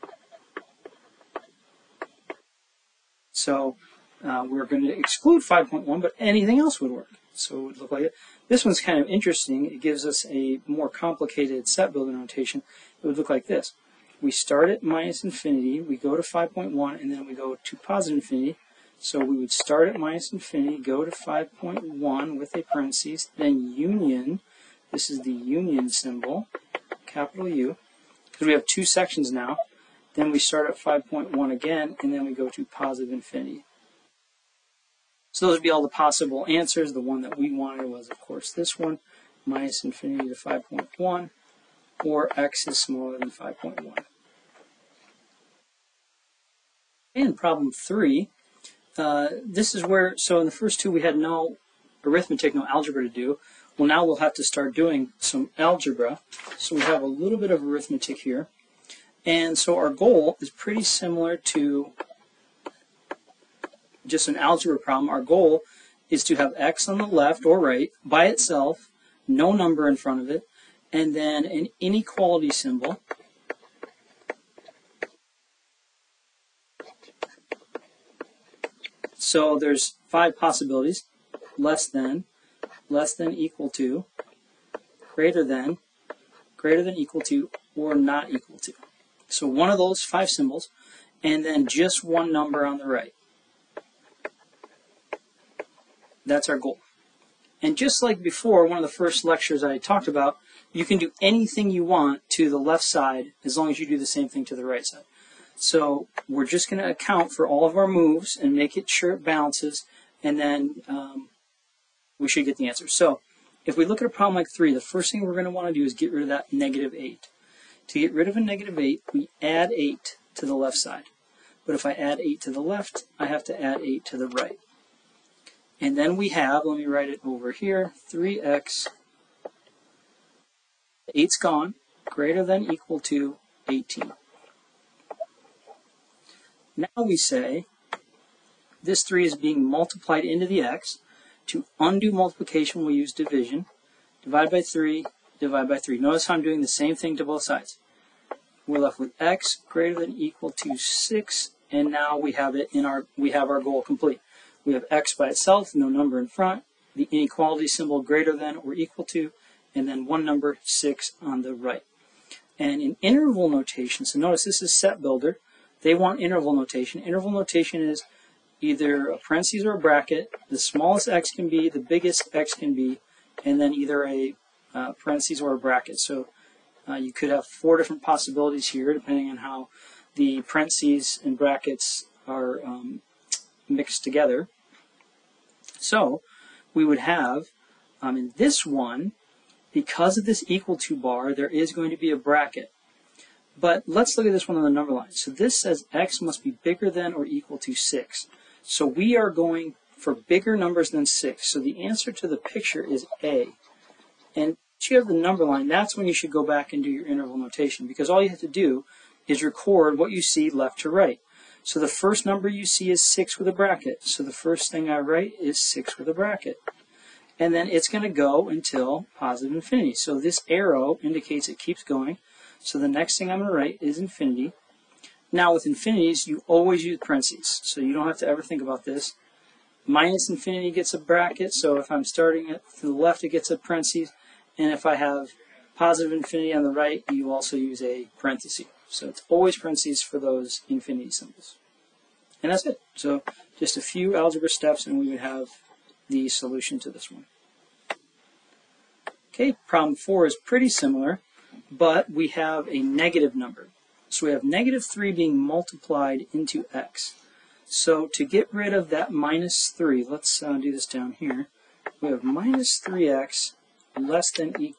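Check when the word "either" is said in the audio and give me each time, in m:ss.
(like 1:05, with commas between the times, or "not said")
2:48, 2:53.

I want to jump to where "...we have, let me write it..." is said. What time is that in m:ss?
2:06.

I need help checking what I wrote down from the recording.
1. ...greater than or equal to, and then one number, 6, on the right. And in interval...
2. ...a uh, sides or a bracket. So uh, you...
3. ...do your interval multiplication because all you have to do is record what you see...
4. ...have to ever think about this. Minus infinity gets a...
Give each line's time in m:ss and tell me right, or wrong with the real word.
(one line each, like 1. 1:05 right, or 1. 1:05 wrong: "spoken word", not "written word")
1. 2:38 right
2. 2:54 wrong: "parentheses", not "sides"
3. 3:26 wrong: "notation", not "multiplication"
4. 3:48 right.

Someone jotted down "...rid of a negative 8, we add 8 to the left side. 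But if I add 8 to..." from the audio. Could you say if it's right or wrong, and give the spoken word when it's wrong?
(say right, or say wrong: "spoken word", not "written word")
right.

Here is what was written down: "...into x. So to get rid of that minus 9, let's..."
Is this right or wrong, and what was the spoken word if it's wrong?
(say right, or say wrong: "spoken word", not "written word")
wrong: "3", not "9".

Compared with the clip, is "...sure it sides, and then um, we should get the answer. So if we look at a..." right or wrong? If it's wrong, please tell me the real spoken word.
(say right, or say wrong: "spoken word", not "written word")
wrong: "balances", not "sides".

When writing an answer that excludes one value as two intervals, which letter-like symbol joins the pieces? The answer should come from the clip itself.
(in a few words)
capital U.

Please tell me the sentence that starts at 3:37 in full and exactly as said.
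And then it's going to go until positive infinity.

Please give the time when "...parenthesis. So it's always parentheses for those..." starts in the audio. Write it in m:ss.
3:58.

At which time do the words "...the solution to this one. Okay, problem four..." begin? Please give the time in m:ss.
4:06.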